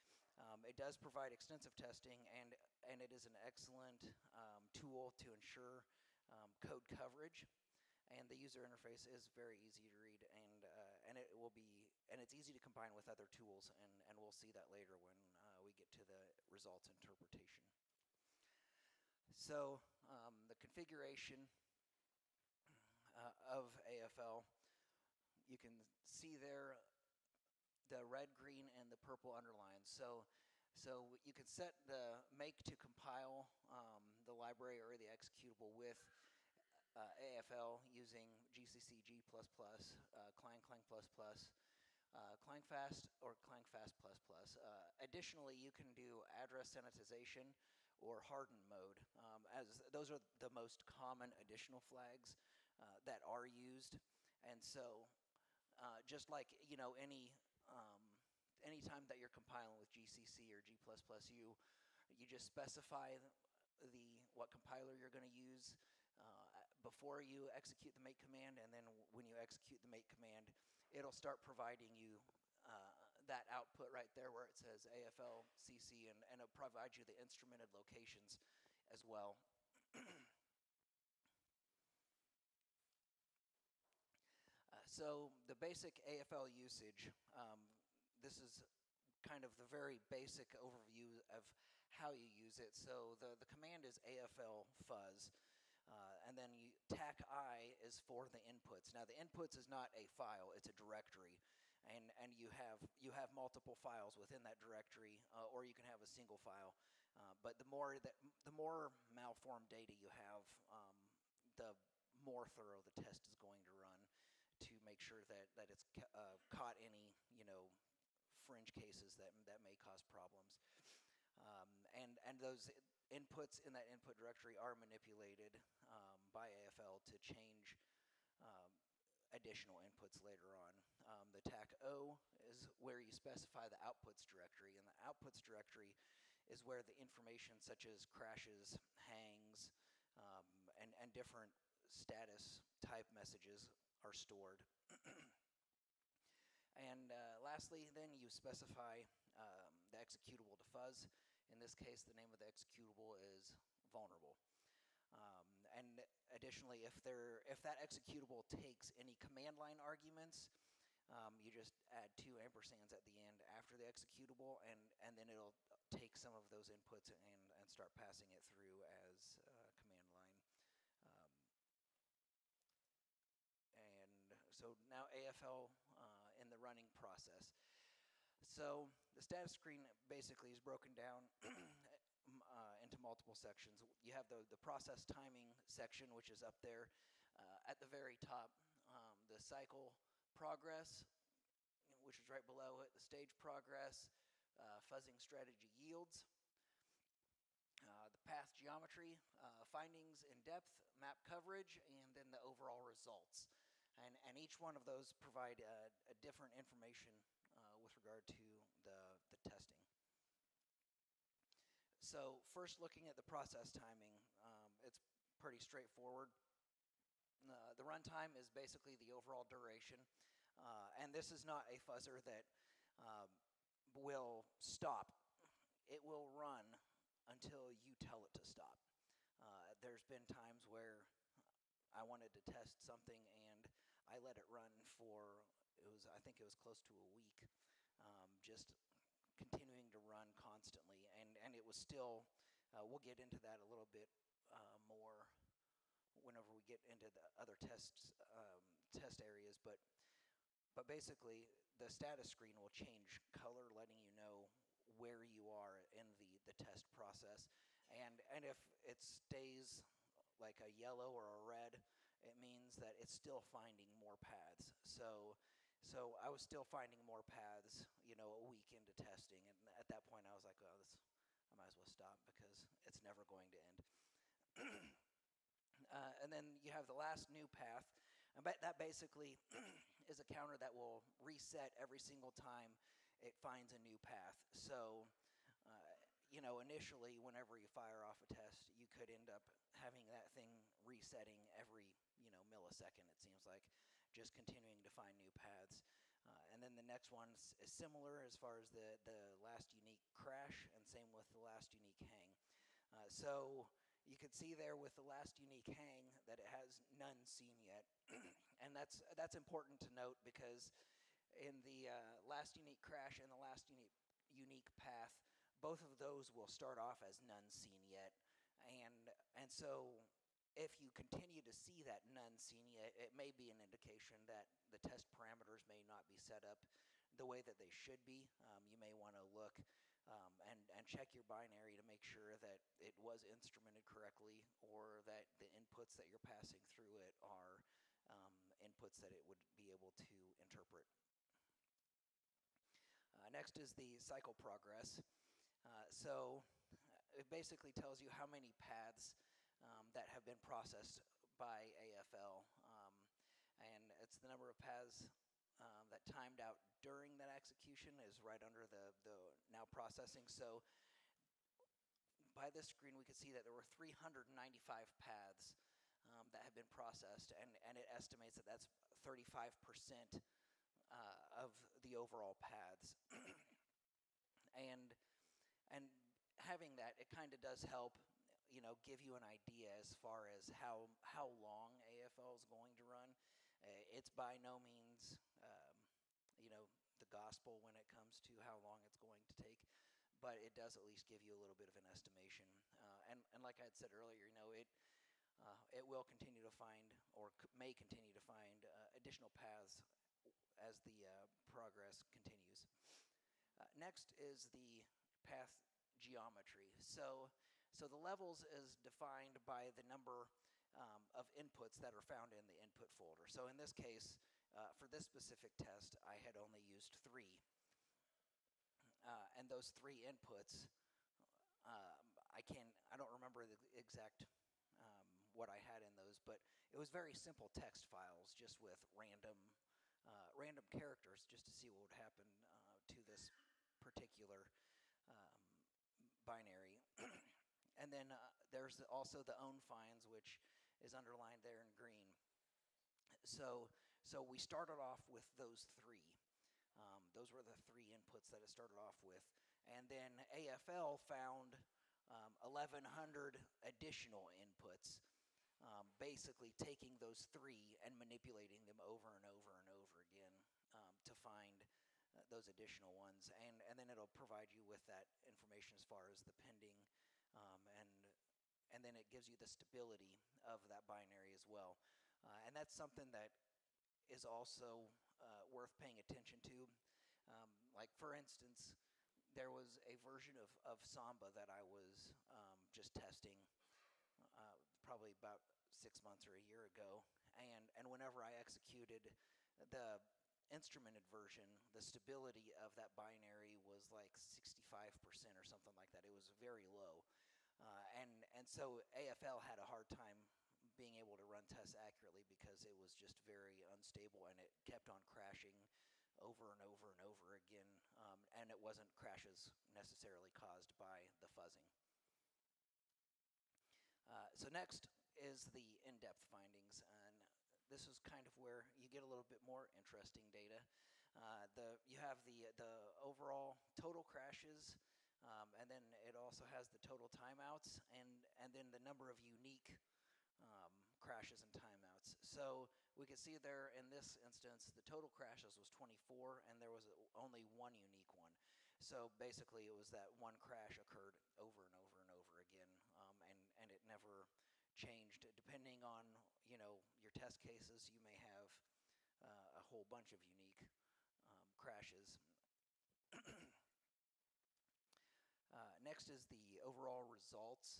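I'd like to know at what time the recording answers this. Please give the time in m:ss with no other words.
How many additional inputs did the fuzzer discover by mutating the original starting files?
7:32.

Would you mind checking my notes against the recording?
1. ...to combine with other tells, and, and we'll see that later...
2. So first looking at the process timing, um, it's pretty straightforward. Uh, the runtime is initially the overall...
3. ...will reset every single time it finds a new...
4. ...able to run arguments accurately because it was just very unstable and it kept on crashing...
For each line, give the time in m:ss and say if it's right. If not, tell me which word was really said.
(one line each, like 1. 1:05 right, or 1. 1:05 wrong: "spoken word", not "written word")
1. 0:12 wrong: "tools", not "tells"
2. 3:32 wrong: "basically", not "initially"
3. 4:40 right
4. 8:20 wrong: "tests", not "arguments".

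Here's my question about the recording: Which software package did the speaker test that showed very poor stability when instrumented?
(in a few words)
Samba.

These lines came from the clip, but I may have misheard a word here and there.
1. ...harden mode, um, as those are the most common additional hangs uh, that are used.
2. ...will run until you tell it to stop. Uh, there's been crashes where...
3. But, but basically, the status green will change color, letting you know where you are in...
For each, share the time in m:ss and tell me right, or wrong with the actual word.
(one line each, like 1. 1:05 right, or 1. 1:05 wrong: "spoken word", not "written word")
1. 0:48 wrong: "flags", not "hangs"
2. 3:46 wrong: "times", not "crashes"
3. 4:09 wrong: "screen", not "green".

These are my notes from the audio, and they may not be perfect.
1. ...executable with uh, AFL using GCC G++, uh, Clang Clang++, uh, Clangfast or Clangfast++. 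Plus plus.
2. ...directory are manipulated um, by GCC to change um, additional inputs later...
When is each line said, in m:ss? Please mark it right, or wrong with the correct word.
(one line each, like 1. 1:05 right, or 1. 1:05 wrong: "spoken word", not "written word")
1. 0:35 right
2. 2:04 wrong: "AFL", not "GCC".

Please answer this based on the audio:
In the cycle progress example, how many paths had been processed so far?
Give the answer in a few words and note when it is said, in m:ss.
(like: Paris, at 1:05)
395, at 6:03.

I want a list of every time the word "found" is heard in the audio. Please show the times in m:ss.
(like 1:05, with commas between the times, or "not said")
6:52, 7:31.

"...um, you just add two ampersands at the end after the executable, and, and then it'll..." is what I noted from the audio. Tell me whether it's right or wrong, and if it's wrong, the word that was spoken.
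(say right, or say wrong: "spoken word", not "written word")
right.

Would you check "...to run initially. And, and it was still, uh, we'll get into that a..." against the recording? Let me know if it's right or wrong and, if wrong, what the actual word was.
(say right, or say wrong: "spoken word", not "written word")
wrong: "constantly", not "initially".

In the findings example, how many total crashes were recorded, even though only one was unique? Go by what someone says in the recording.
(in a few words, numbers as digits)
24.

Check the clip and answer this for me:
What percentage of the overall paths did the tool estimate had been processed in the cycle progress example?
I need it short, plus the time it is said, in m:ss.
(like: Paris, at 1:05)
35%, at 6:09.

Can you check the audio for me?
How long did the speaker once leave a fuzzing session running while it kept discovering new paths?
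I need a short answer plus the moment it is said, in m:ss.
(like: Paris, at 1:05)
close to a week, at 3:56.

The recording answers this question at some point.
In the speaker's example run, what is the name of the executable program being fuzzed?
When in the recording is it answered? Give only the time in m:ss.
2:33.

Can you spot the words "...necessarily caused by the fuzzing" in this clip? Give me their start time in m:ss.
8:29.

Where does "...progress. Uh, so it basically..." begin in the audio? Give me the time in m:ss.
5:44.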